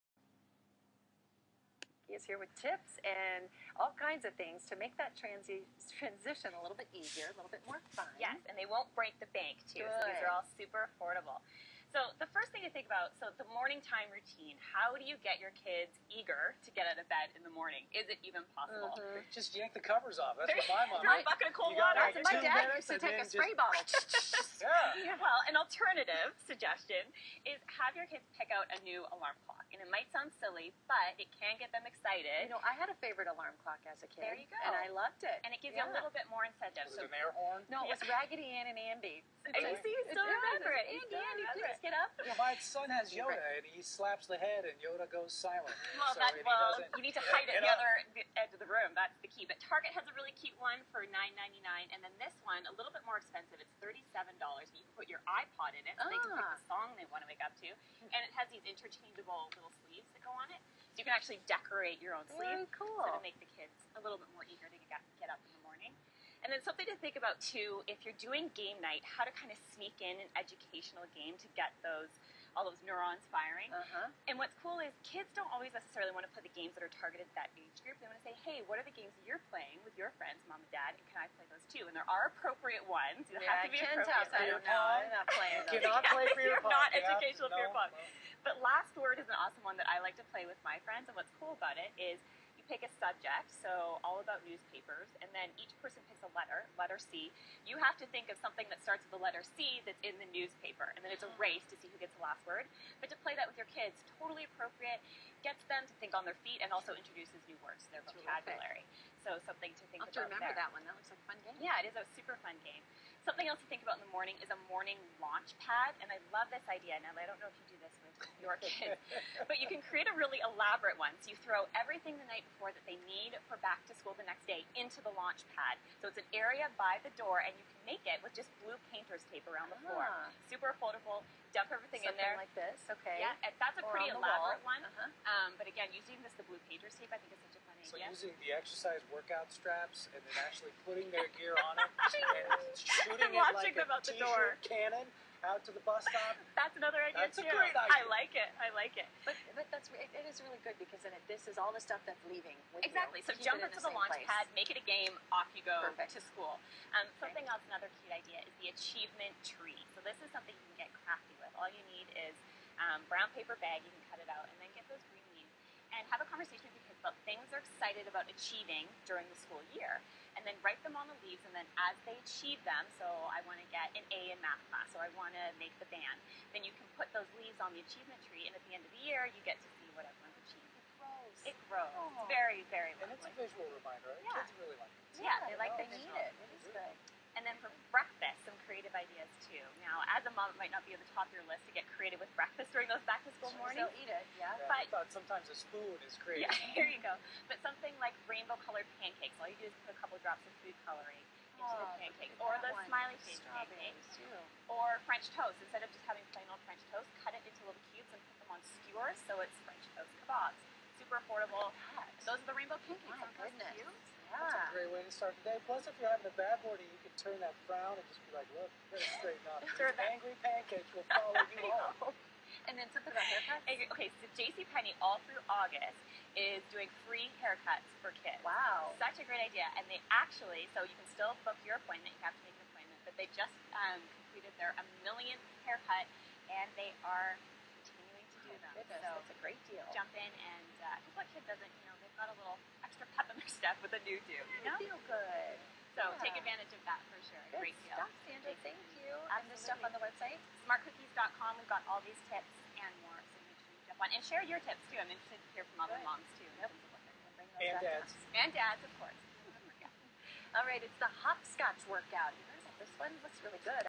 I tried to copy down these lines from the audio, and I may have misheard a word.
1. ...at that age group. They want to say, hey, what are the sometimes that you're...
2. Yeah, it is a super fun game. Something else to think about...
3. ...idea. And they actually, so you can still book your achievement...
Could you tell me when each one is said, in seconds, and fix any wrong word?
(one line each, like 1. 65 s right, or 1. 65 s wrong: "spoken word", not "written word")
1. 77 s wrong: "games", not "sometimes"
2. 111 s right
3. 229 s wrong: "appointment", not "achievement".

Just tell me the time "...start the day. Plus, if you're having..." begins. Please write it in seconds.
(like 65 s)
215 s.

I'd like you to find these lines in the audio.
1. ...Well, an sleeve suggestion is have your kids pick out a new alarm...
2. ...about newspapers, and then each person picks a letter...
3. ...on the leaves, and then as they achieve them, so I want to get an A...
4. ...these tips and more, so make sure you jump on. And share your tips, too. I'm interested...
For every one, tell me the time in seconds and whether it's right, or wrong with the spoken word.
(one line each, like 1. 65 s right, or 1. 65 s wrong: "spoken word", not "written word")
1. 25 s wrong: "alternative", not "sleeve"
2. 94 s right
3. 170 s right
4. 252 s right.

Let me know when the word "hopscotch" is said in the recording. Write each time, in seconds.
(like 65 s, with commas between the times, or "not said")
261 s.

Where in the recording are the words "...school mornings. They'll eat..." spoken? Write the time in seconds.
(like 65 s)
193 s.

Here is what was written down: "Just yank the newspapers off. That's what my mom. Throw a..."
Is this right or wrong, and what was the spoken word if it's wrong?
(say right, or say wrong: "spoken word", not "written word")
wrong: "covers", not "newspapers".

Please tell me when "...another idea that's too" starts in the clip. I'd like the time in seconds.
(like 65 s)
146 s.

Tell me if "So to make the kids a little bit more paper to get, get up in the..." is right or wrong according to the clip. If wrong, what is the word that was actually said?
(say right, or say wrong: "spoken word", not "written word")
wrong: "eager", not "paper".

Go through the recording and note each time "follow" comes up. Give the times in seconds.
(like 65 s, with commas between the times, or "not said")
221 s.